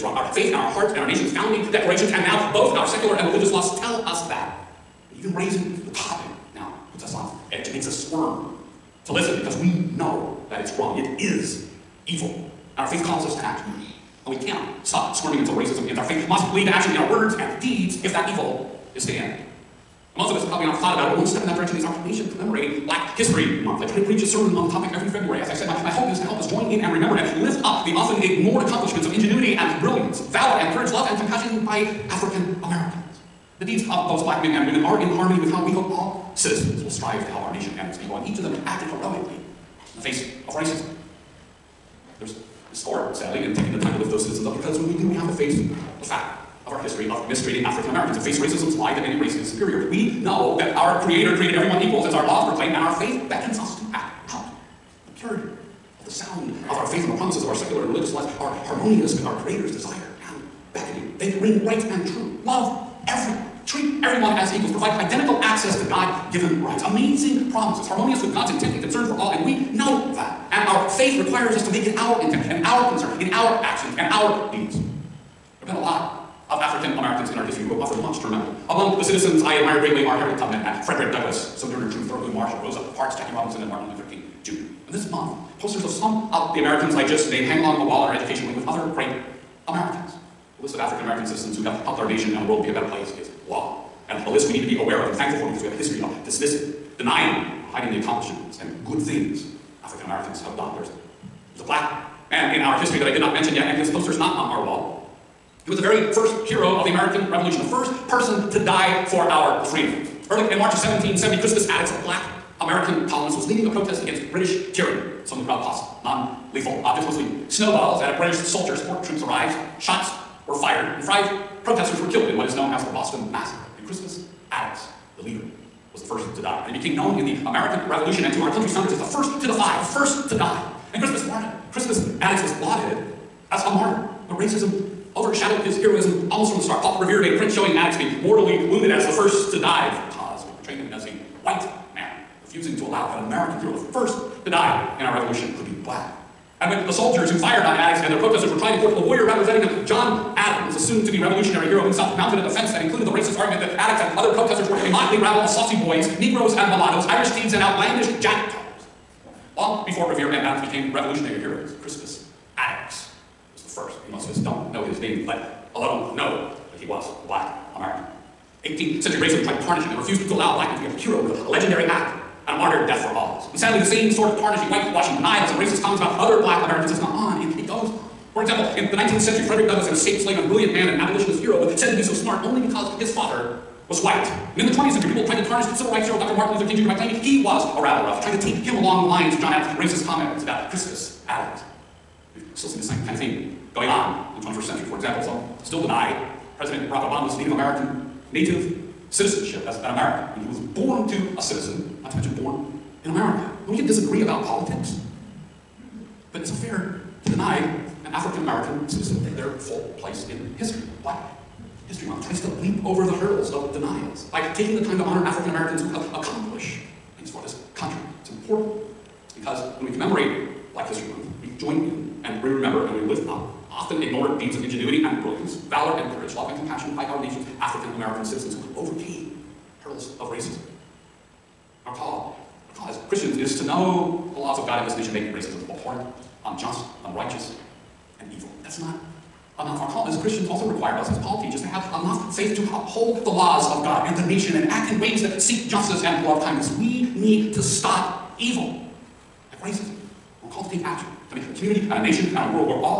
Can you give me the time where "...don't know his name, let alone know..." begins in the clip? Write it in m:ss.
2:44.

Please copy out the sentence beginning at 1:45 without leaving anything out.
He was the very first hero of the American Revolution, the first person to die for our freedom.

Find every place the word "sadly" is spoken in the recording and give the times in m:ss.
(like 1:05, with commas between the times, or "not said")
0:43, 2:53.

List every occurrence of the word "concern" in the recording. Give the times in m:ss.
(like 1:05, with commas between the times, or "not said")
1:08, 1:12.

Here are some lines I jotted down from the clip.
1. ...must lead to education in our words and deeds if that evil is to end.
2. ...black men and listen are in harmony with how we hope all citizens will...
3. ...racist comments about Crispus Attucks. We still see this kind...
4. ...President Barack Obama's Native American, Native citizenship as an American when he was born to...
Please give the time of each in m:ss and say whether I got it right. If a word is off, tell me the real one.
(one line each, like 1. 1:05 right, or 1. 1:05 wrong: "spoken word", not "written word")
1. 0:16 wrong: "action", not "education"
2. 0:34 wrong: "women", not "listen"
3. 3:09 right
4. 3:16 right.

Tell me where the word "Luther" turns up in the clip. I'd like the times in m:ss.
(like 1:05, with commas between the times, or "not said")
1:23, 3:06.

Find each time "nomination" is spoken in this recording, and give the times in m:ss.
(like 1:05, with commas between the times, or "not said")
not said.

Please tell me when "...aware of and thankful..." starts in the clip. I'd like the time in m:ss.
1:34.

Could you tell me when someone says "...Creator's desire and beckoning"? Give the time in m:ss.
0:59.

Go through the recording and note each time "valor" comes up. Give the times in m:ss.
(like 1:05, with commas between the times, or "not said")
0:30, 3:45.